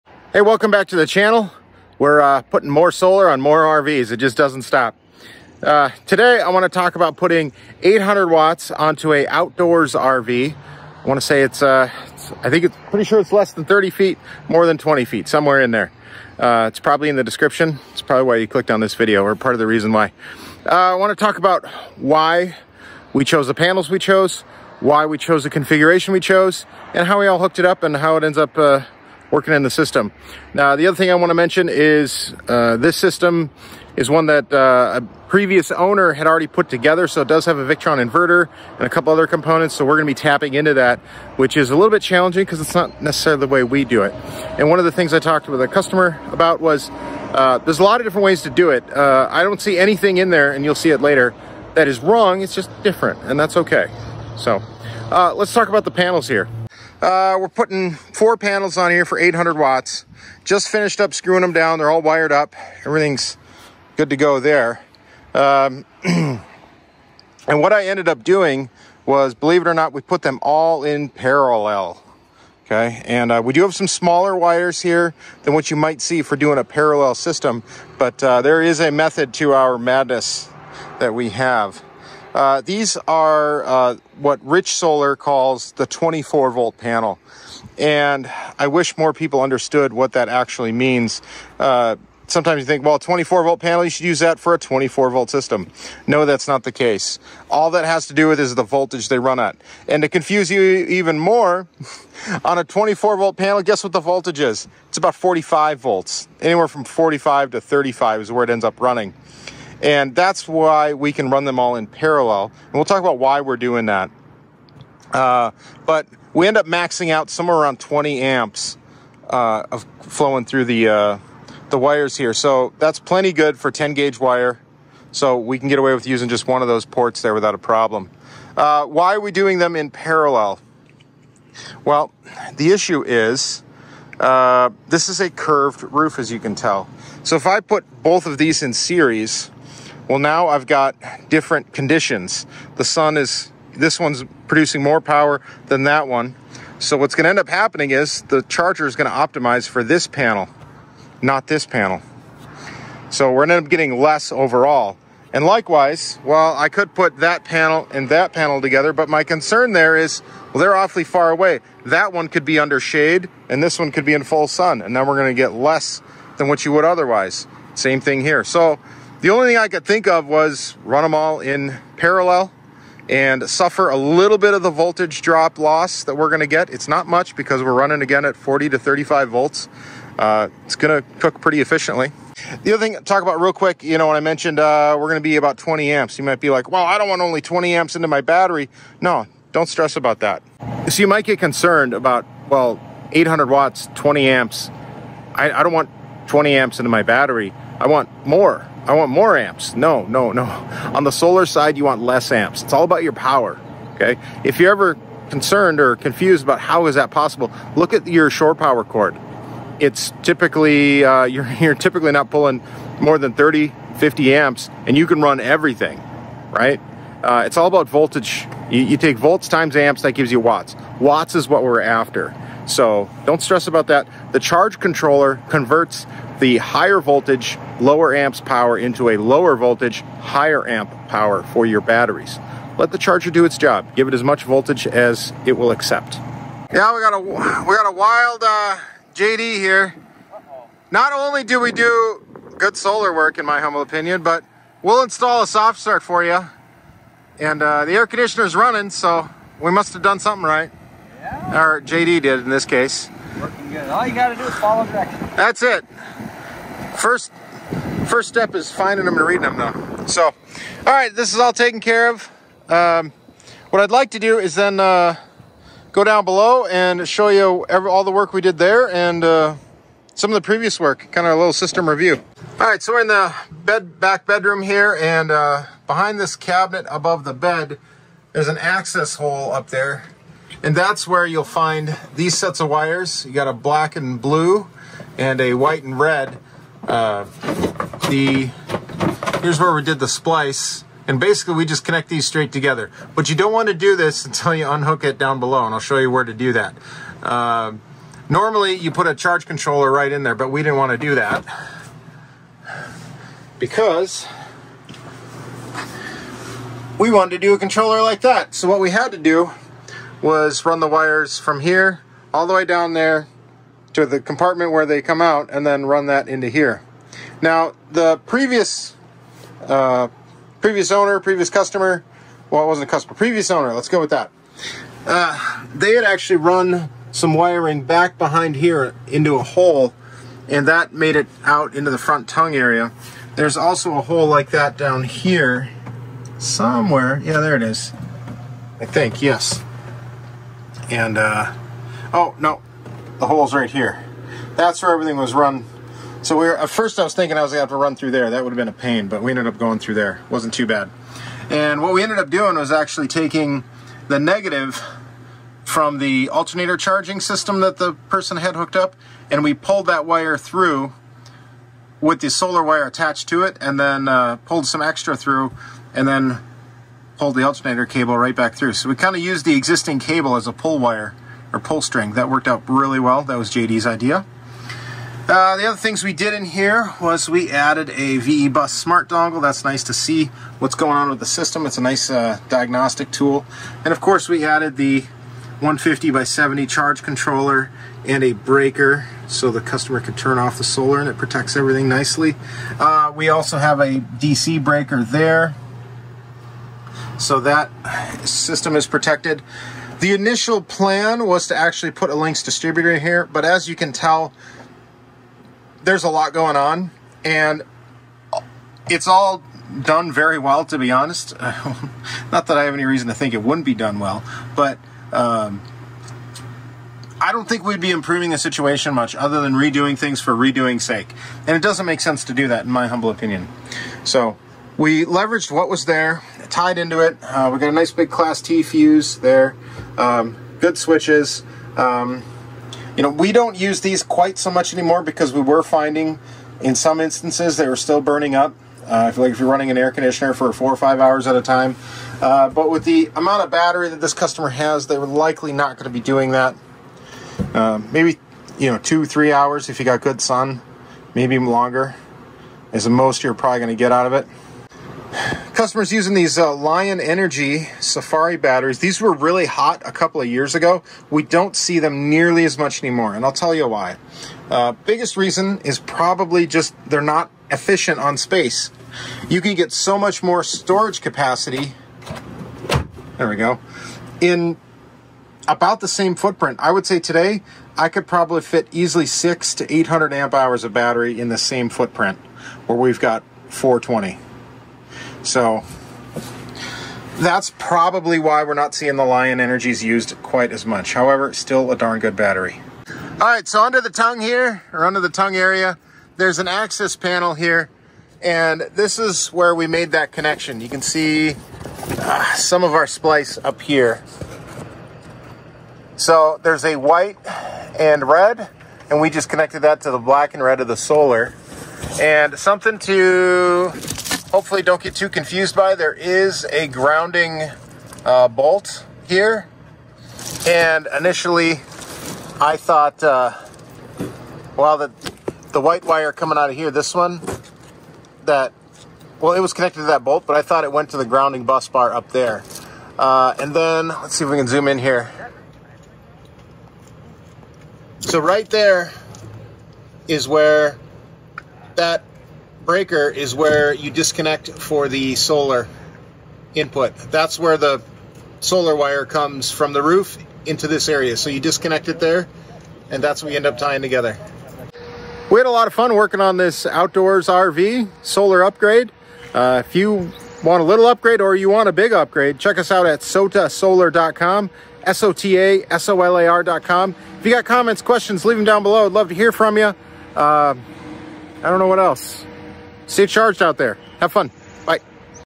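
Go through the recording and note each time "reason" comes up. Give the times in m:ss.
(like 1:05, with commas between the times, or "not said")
0:19, 6:52, 7:45.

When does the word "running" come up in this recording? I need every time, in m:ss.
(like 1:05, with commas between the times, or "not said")
1:48, 2:57, 4:08, 7:19.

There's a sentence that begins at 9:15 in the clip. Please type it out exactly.
We had a lot of fun working on this outdoors RV solar upgrade.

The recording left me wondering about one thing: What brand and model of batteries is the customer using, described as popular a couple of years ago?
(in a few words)
Lion Energy Safari.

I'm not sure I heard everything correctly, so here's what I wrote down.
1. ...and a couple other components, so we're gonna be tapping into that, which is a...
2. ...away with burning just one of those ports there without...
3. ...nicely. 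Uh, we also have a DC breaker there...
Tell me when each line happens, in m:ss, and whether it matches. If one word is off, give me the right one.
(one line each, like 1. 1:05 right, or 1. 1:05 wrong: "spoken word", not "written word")
1. 0:38 right
2. 2:05 wrong: "using", not "burning"
3. 6:31 right.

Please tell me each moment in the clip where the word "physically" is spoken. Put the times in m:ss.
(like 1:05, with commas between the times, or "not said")
not said.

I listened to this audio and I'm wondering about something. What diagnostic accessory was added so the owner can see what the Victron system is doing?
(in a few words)
VE Bus smart dongle.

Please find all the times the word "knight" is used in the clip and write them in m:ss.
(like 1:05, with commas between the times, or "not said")
not said.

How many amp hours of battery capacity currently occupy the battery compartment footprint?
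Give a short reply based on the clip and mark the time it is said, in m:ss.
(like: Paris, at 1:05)
420, at 8:03.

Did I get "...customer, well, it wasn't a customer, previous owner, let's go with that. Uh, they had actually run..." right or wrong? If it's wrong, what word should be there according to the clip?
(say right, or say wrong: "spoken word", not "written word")
right.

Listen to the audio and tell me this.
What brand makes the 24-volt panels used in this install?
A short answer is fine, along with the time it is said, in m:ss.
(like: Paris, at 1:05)
Rich Solar, at 1:24.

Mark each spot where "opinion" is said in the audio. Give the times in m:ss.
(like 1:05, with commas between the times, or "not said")
4:03, 7:03.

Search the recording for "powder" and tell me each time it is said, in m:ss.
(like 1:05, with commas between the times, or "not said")
not said.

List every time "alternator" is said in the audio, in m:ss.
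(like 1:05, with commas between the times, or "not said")
5:56, 6:07.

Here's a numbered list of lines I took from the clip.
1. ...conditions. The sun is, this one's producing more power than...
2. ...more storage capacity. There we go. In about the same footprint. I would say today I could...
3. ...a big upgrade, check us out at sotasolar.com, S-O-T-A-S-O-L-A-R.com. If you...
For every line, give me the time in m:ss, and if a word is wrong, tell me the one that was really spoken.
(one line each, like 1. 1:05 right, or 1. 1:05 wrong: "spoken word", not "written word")
1. 2:21 right
2. 7:50 right
3. 9:21 right.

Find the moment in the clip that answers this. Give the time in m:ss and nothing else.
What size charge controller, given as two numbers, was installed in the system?
6:25.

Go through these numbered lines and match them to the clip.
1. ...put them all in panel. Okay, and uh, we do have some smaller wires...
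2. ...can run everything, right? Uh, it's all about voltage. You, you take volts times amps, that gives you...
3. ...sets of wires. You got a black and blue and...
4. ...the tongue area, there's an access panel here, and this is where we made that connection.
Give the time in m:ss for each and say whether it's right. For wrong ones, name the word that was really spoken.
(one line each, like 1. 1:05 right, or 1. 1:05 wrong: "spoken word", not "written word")
1. 1:10 wrong: "parallel", not "panel"
2. 3:35 right
3. 4:42 right
4. 8:14 right.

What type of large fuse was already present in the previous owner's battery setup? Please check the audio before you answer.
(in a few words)
Class T.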